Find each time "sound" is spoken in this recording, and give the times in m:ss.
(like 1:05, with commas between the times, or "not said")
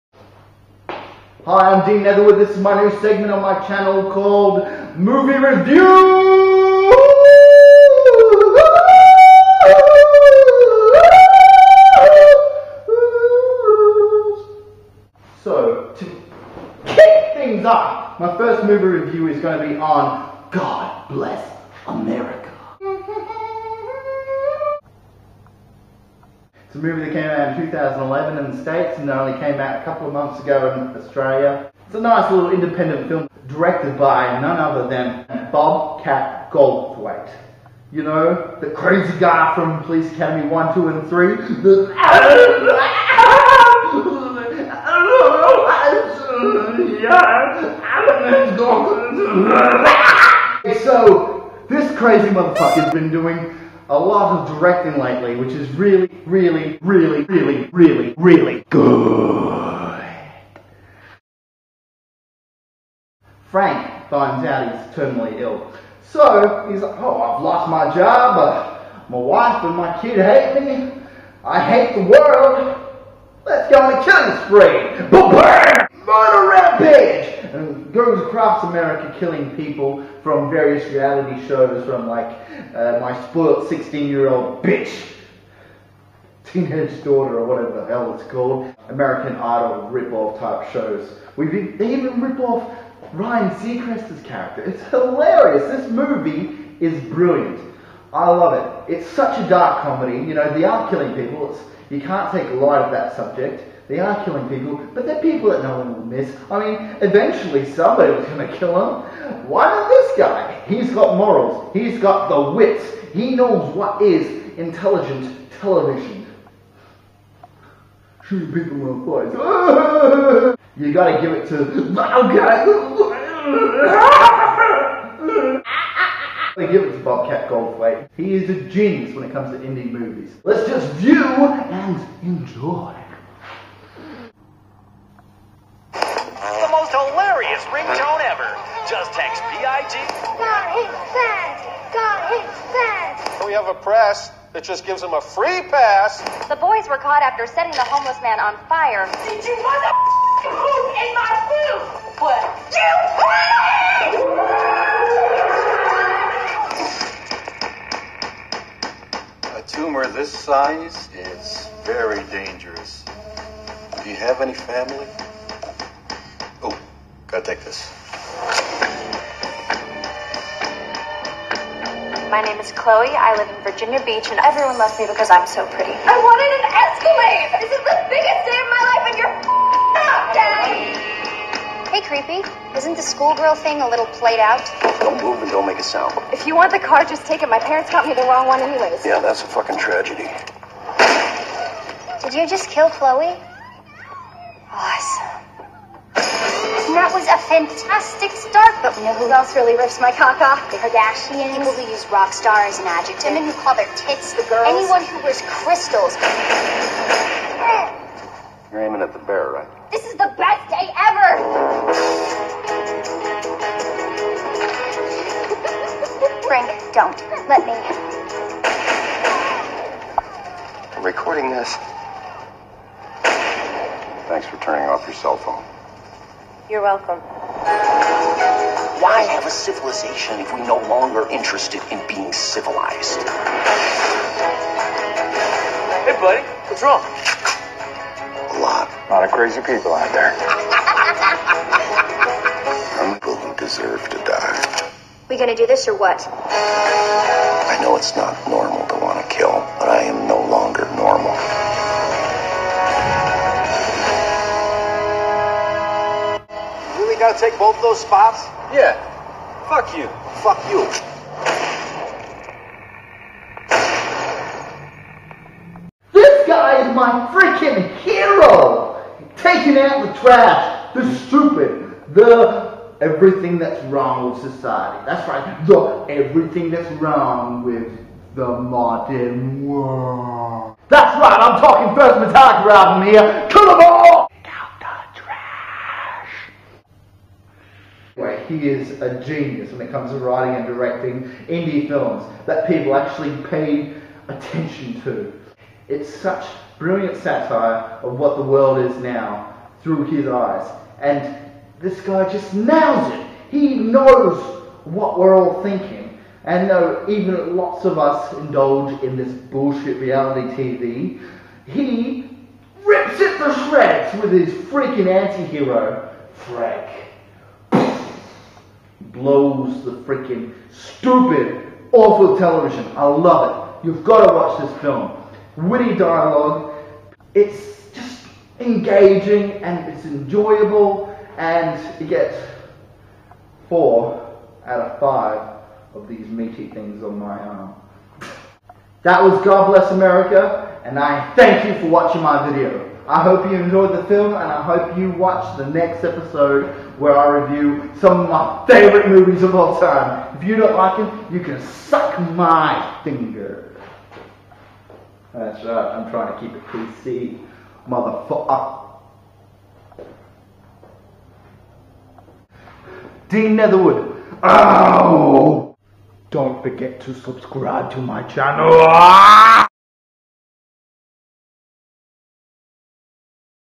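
3:05.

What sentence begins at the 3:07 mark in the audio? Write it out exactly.
My parents got me the wrong one, anyways.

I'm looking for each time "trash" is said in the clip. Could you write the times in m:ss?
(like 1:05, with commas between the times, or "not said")
4:30, 4:45.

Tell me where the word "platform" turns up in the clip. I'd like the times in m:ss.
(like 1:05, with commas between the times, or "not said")
not said.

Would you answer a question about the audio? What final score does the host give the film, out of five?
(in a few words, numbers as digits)
4.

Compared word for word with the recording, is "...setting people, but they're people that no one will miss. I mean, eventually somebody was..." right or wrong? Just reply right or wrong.
wrong.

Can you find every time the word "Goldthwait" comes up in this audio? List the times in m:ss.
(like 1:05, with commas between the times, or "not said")
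0:36, 2:07.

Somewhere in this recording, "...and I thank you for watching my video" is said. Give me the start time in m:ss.
5:40.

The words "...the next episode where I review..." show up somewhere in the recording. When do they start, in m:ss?
5:45.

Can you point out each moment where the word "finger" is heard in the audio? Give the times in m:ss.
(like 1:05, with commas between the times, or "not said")
5:53.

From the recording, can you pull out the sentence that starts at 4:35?
That's right, the everything that's wrong with the modern world.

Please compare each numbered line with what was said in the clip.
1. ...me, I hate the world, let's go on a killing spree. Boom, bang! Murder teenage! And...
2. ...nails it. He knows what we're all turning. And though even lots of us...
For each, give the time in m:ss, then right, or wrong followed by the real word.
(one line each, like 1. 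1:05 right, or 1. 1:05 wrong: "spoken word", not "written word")
1. 1:10 wrong: "rampage", not "teenage"
2. 5:02 wrong: "thinking", not "turning".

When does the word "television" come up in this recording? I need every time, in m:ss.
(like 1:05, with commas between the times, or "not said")
1:55, 5:22.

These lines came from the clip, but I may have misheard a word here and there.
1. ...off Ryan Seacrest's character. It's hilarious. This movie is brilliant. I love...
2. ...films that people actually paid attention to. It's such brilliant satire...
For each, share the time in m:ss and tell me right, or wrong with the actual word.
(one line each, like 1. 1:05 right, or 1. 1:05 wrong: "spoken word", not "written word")
1. 1:32 right
2. 4:51 right.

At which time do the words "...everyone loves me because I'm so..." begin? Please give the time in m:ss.
2:54.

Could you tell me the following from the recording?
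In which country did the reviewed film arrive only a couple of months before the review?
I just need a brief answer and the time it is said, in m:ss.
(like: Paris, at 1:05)
Australia, at 0:31.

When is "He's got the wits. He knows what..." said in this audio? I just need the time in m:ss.
1:51.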